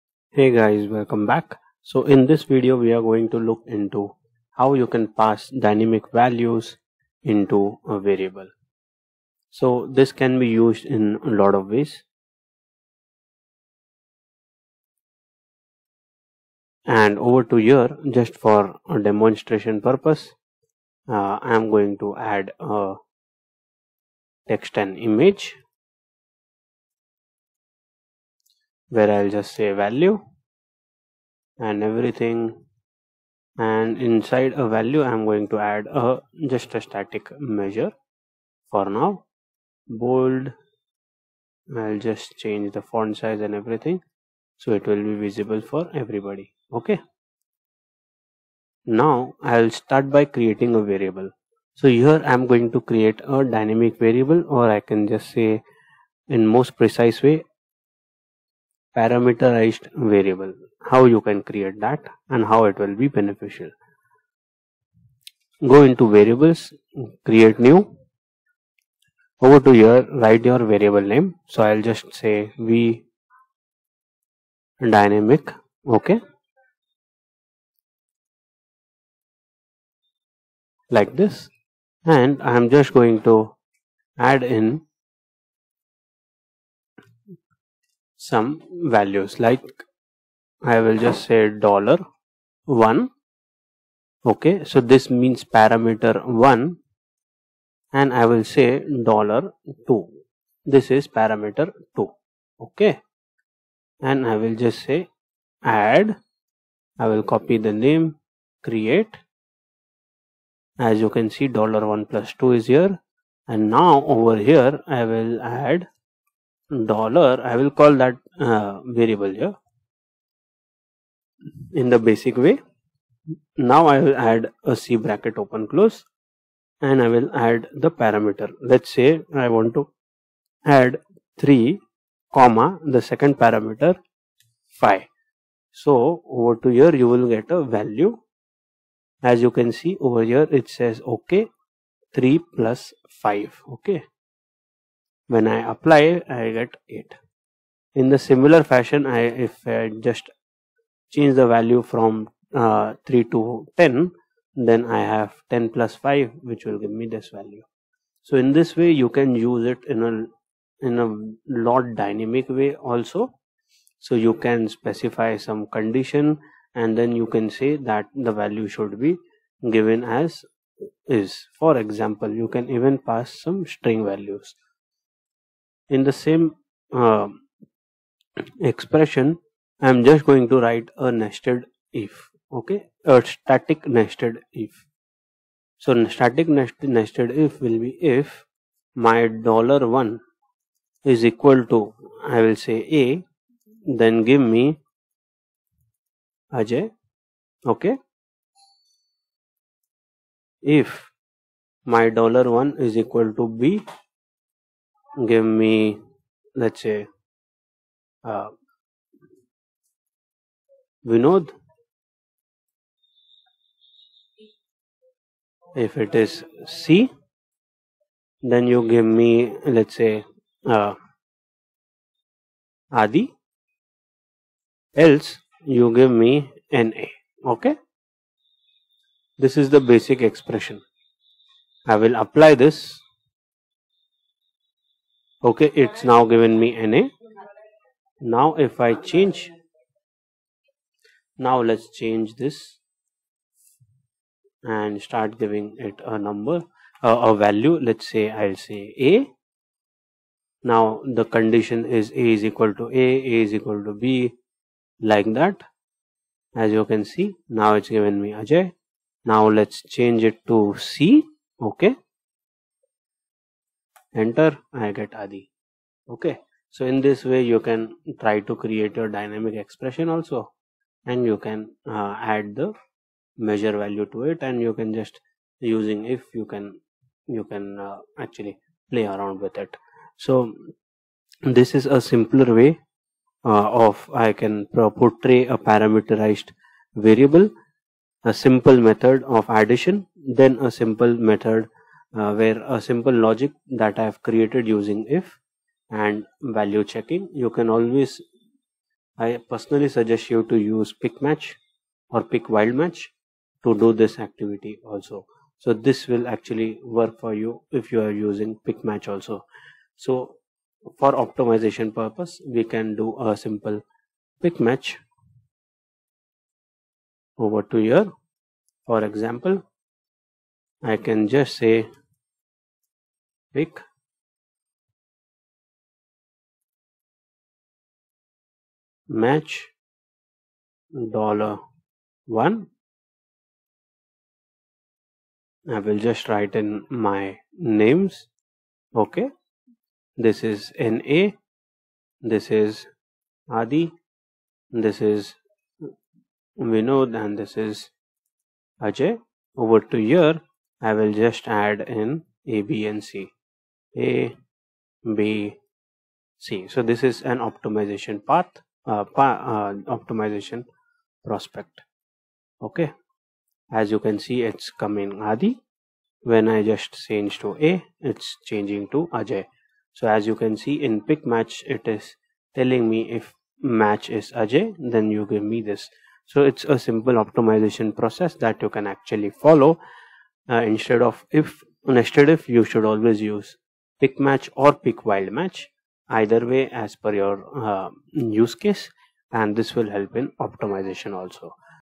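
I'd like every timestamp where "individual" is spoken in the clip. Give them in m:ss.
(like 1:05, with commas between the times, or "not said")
not said.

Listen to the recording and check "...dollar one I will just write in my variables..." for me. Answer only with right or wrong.
wrong.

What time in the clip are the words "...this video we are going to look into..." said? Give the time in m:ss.
0:02.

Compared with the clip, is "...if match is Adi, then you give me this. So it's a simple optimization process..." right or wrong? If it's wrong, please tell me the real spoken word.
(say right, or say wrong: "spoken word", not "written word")
wrong: "Ajay", not "Adi".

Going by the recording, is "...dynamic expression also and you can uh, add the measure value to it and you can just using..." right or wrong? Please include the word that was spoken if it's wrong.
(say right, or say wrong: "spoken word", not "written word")
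right.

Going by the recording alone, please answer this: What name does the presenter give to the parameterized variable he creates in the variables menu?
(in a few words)
v dynamic.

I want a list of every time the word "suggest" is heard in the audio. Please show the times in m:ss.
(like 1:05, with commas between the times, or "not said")
4:59.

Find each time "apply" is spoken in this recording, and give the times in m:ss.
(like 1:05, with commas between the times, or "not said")
2:25, 3:52.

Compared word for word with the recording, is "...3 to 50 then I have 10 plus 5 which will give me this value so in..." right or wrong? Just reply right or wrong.
wrong.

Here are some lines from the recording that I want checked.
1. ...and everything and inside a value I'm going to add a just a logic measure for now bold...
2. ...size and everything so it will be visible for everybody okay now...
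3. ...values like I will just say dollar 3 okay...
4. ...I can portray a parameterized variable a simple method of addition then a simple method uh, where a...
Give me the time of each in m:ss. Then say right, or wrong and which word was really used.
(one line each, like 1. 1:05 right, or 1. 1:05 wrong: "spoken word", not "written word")
1. 0:31 wrong: "static", not "logic"
2. 0:43 right
3. 1:28 wrong: "1", not "3"
4. 4:44 right.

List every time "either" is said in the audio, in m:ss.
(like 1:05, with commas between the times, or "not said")
6:26.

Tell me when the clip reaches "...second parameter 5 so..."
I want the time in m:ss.
2:13.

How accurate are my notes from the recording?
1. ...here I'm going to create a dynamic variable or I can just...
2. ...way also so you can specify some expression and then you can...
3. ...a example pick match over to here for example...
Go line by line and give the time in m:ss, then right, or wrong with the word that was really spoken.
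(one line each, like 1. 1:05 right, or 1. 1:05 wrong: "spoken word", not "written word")
1. 0:51 right
2. 2:42 wrong: "condition", not "expression"
3. 5:13 wrong: "simple", not "example".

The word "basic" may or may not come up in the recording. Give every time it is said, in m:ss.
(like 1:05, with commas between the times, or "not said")
2:01, 3:49.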